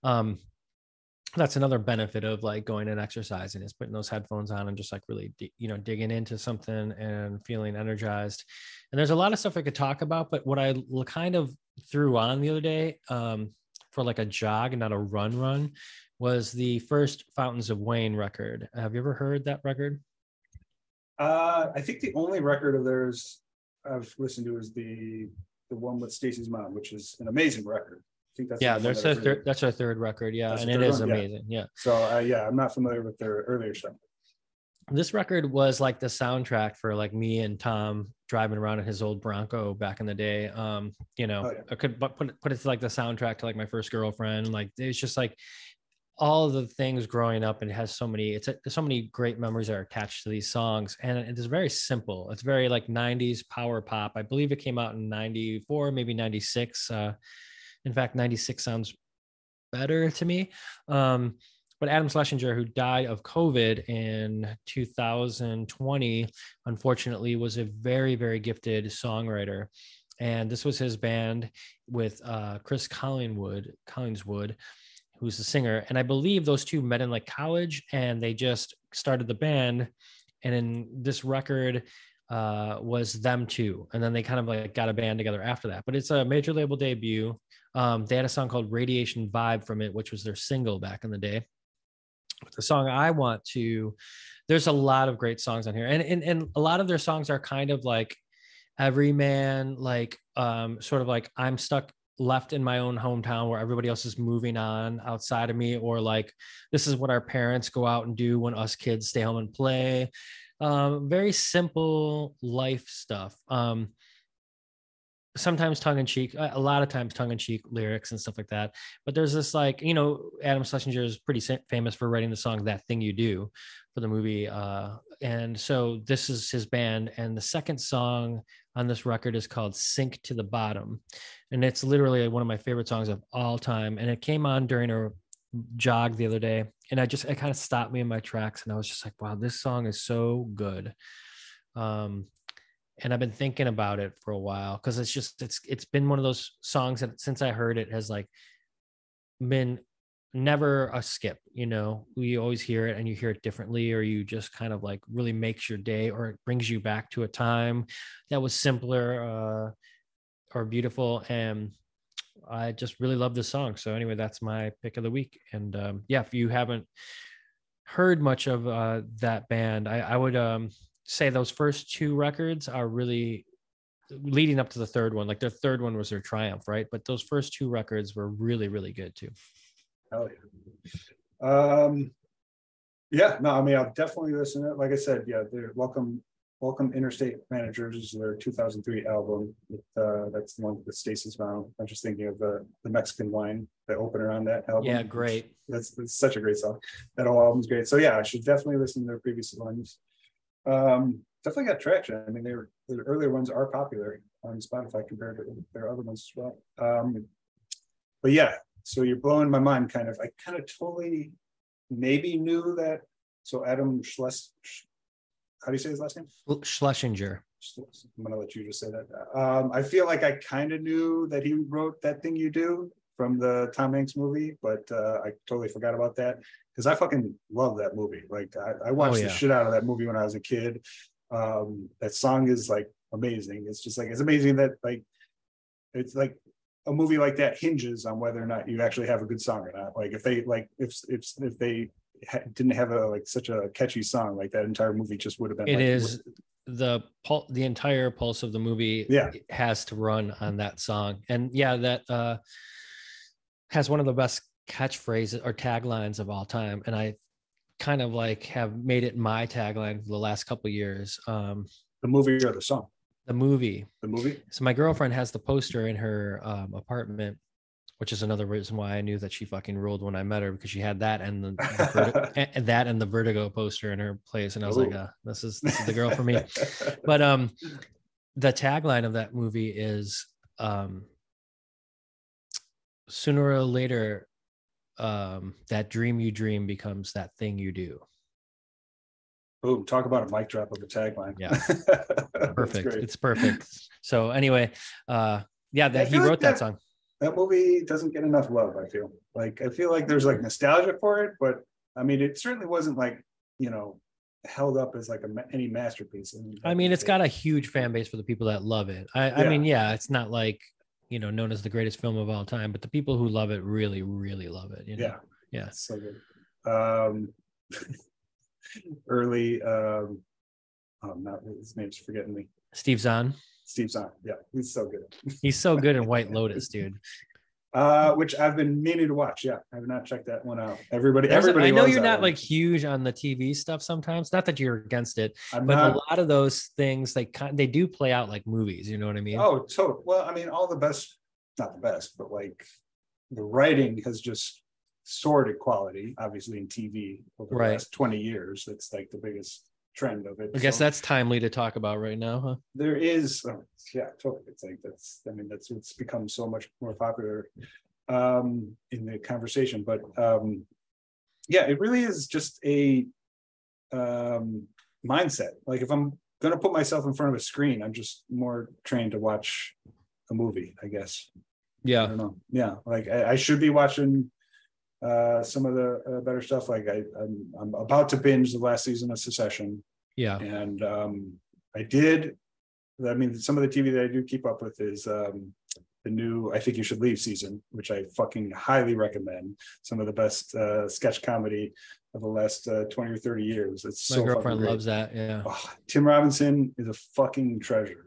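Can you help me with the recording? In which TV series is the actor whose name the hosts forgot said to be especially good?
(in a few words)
White Lotus.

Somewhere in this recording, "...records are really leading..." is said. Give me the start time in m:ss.
2:52.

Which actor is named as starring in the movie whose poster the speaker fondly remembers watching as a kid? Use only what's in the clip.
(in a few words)
Tom Hanks.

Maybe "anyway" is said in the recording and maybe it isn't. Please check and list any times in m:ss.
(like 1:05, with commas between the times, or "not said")
2:43, 4:54.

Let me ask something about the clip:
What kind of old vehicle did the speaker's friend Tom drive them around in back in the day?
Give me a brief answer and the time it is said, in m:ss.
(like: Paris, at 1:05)
Bronco, at 0:39.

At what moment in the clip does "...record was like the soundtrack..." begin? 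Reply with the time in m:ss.
0:35.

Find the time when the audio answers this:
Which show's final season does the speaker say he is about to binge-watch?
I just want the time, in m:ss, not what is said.
6:19.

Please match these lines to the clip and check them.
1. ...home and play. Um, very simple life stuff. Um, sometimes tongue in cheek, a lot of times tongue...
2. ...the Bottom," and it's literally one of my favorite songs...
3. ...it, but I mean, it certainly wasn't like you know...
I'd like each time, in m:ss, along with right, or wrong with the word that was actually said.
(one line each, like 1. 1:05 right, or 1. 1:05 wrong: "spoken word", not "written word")
1. 1:49 right
2. 2:10 right
3. 5:01 right.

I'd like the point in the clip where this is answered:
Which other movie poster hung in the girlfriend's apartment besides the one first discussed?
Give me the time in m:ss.
4:33.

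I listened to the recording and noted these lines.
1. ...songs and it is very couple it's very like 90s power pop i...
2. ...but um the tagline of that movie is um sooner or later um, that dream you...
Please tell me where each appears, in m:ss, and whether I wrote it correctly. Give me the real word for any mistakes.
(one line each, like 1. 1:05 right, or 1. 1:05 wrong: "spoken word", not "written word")
1. 0:50 wrong: "simple", not "couple"
2. 4:37 right.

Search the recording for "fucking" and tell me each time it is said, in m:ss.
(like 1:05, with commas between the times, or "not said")
3:46, 4:29, 6:28, 6:37.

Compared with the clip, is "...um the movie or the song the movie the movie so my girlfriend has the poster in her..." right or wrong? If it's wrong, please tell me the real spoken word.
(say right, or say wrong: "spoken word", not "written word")
right.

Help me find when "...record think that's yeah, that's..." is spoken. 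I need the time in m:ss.
0:27.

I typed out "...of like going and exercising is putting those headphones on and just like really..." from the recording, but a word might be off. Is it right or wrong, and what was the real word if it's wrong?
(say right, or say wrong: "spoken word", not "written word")
right.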